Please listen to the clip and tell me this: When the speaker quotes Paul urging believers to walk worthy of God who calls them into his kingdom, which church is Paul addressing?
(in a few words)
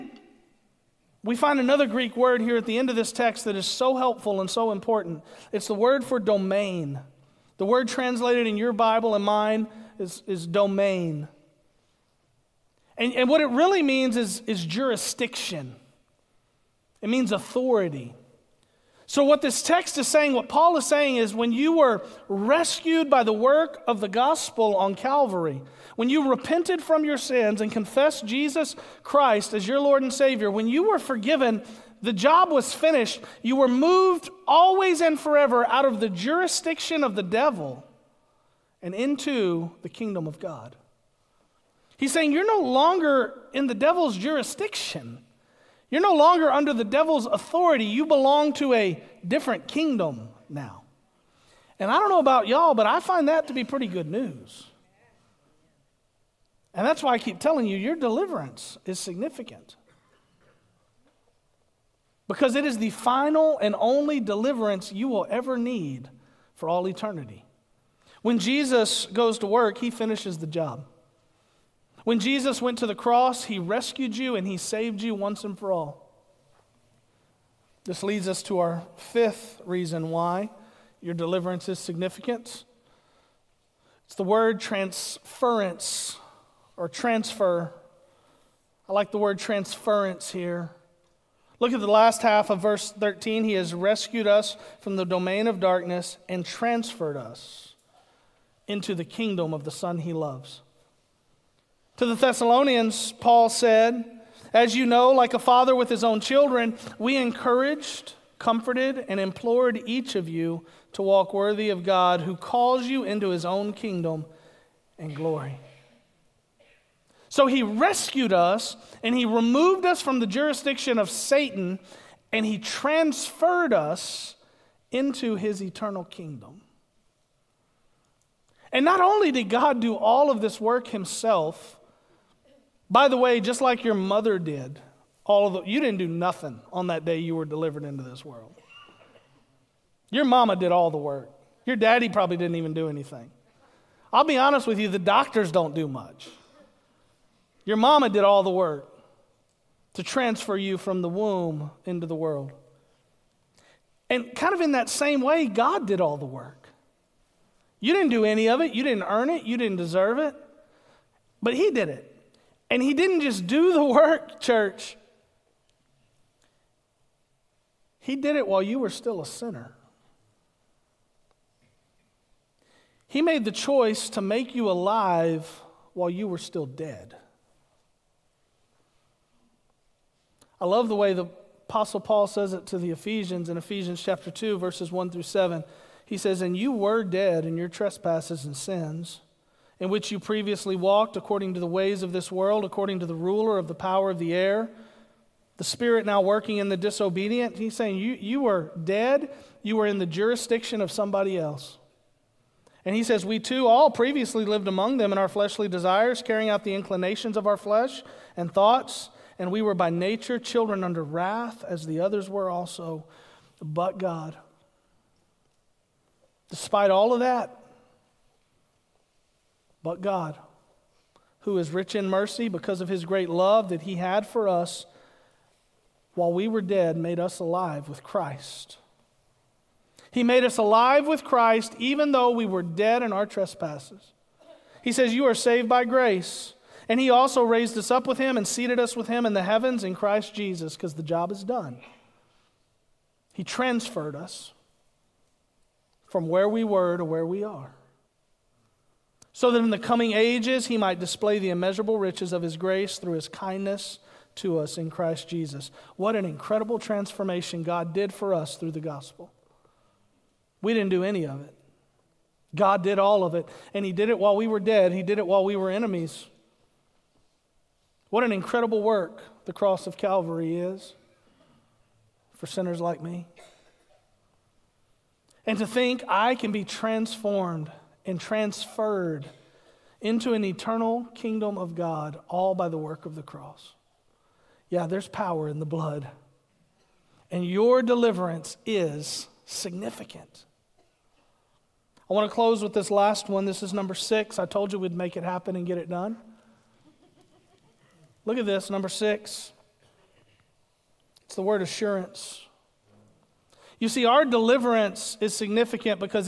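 the Thessalonians.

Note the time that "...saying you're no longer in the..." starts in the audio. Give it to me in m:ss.
0:42.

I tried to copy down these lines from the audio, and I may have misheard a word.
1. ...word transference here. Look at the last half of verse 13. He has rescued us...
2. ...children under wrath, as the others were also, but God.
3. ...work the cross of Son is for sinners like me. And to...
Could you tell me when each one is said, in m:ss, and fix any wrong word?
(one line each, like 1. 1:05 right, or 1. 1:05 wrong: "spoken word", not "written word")
1. 1:29 right
2. 3:30 right
3. 4:28 wrong: "Calvary", not "Son".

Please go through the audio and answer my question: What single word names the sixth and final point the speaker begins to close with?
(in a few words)
assurance.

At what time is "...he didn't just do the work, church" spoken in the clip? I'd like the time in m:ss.
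2:42.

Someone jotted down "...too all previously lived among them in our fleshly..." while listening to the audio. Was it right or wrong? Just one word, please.
right.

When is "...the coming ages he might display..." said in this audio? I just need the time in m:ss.
4:09.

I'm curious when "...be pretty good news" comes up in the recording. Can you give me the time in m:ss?
0:53.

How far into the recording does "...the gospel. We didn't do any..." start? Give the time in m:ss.
4:18.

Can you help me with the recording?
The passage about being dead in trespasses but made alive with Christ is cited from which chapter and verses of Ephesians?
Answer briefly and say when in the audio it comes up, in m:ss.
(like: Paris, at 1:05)
2:1-7, at 3:04.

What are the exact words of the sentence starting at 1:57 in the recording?
So he rescued us and he removed us from the jurisdiction of Satan and he transferred us into his eternal kingdom.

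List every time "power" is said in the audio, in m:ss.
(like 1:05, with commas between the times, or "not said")
3:13, 4:45.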